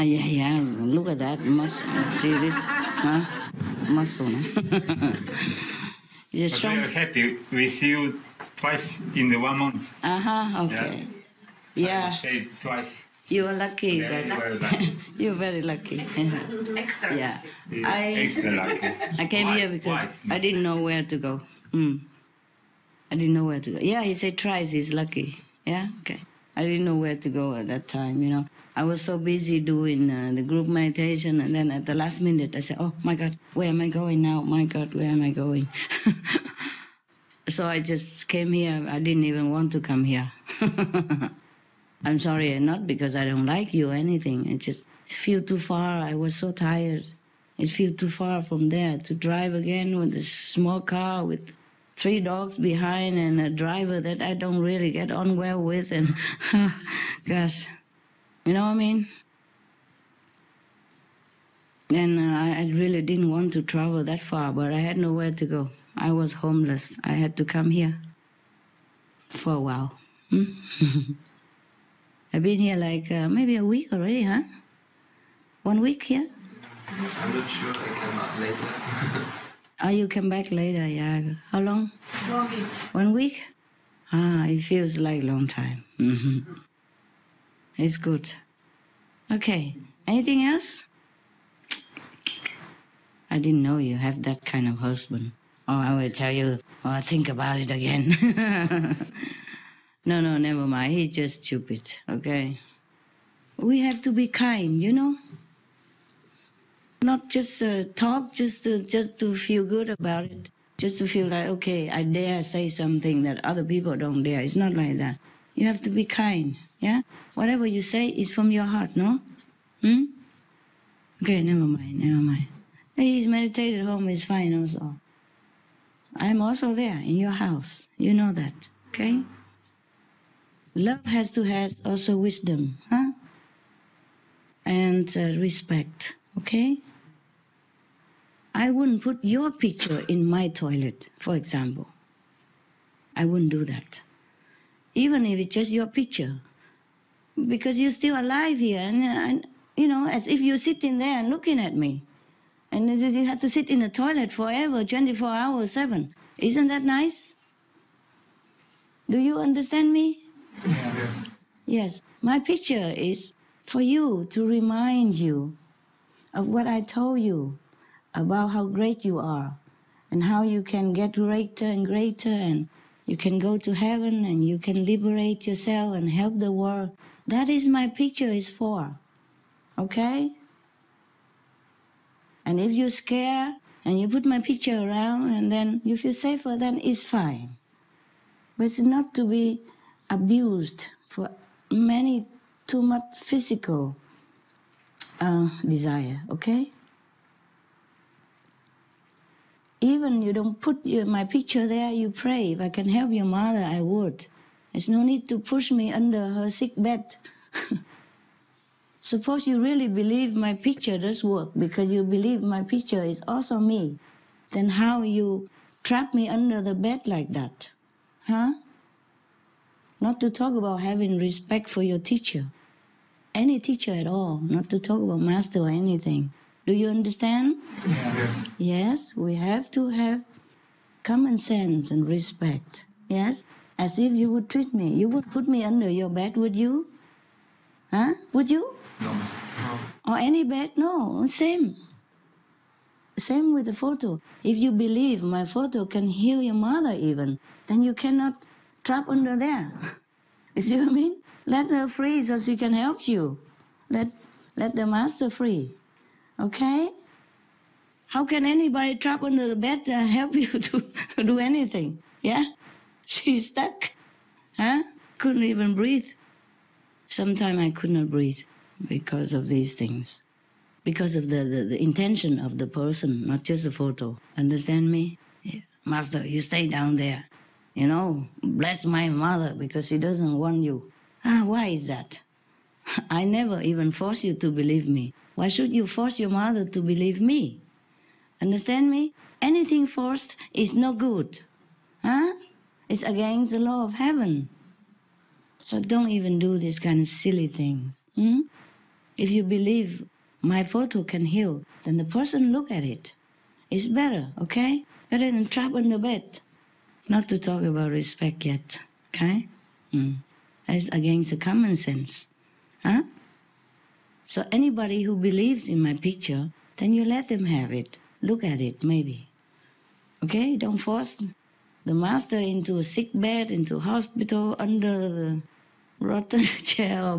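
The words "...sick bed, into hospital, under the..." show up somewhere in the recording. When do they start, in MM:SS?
05:22.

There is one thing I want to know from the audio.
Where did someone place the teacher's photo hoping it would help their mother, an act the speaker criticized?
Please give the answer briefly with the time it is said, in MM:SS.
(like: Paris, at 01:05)
under her sick bed, at 03:25.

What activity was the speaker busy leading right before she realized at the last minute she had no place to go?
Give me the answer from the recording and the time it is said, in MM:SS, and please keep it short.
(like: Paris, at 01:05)
group meditation, at 00:30.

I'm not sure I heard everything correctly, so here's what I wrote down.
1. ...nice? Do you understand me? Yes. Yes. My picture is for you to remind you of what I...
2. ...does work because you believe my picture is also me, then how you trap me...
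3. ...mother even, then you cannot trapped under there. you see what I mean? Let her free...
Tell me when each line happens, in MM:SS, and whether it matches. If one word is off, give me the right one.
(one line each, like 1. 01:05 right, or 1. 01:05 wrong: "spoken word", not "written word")
1. 02:36 right
2. 03:30 right
3. 04:06 right.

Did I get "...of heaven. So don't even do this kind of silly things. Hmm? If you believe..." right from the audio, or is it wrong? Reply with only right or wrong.
right.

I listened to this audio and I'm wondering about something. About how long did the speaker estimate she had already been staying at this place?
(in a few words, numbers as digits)
1 week.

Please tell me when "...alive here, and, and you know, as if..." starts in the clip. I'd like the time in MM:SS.
02:28.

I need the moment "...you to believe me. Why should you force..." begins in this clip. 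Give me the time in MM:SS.
04:44.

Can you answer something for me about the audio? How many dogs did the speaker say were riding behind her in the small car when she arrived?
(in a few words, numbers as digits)
3.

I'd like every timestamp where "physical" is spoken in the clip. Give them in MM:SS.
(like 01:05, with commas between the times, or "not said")
03:13.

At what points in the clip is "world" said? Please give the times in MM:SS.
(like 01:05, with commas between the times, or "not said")
02:56.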